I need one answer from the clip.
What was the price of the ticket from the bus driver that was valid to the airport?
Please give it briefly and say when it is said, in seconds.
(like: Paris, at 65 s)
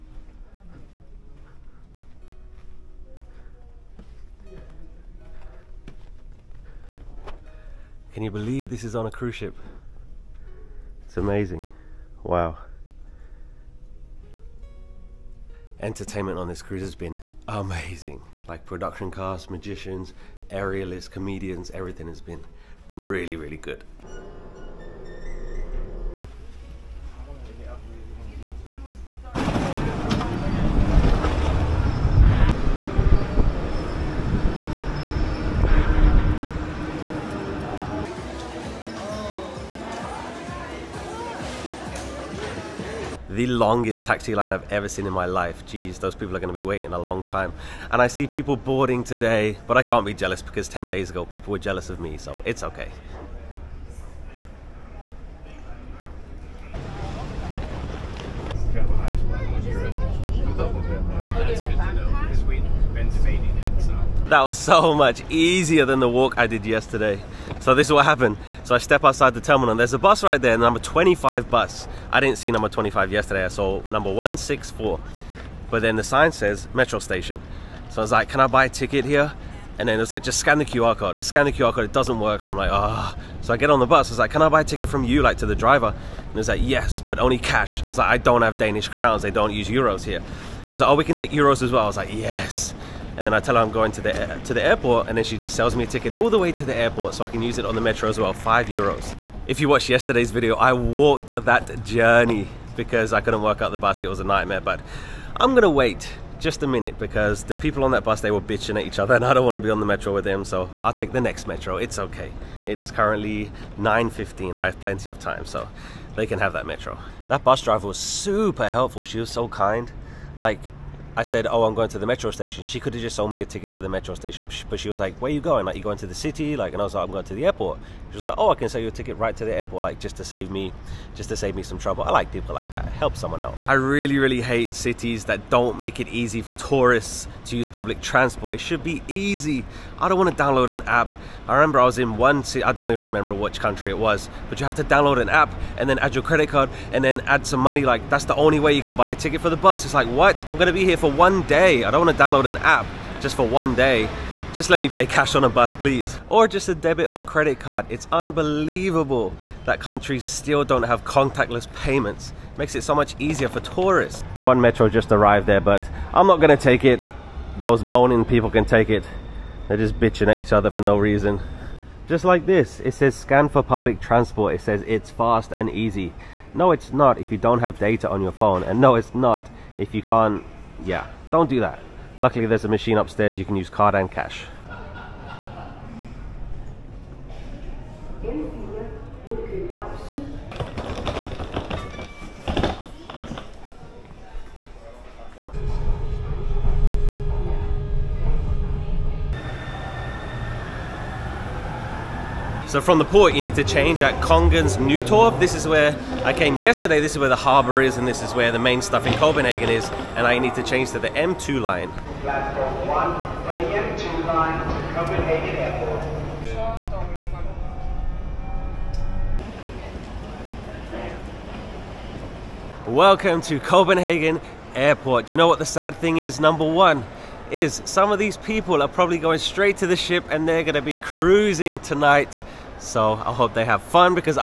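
5 euros, at 98 s.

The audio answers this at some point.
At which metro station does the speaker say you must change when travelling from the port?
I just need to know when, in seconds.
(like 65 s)
204 s.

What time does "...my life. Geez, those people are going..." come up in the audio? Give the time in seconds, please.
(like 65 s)
45 s.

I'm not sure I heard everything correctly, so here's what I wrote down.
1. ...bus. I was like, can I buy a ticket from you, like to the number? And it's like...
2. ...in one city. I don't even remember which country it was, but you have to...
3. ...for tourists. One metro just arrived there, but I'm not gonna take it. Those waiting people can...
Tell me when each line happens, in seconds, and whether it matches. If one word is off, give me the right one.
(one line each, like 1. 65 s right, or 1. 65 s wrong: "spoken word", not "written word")
1. 83 s wrong: "driver", not "number"
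2. 141 s right
3. 163 s wrong: "moaning", not "waiting".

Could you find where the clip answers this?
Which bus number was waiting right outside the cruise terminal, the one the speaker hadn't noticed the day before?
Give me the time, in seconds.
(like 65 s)
70 s.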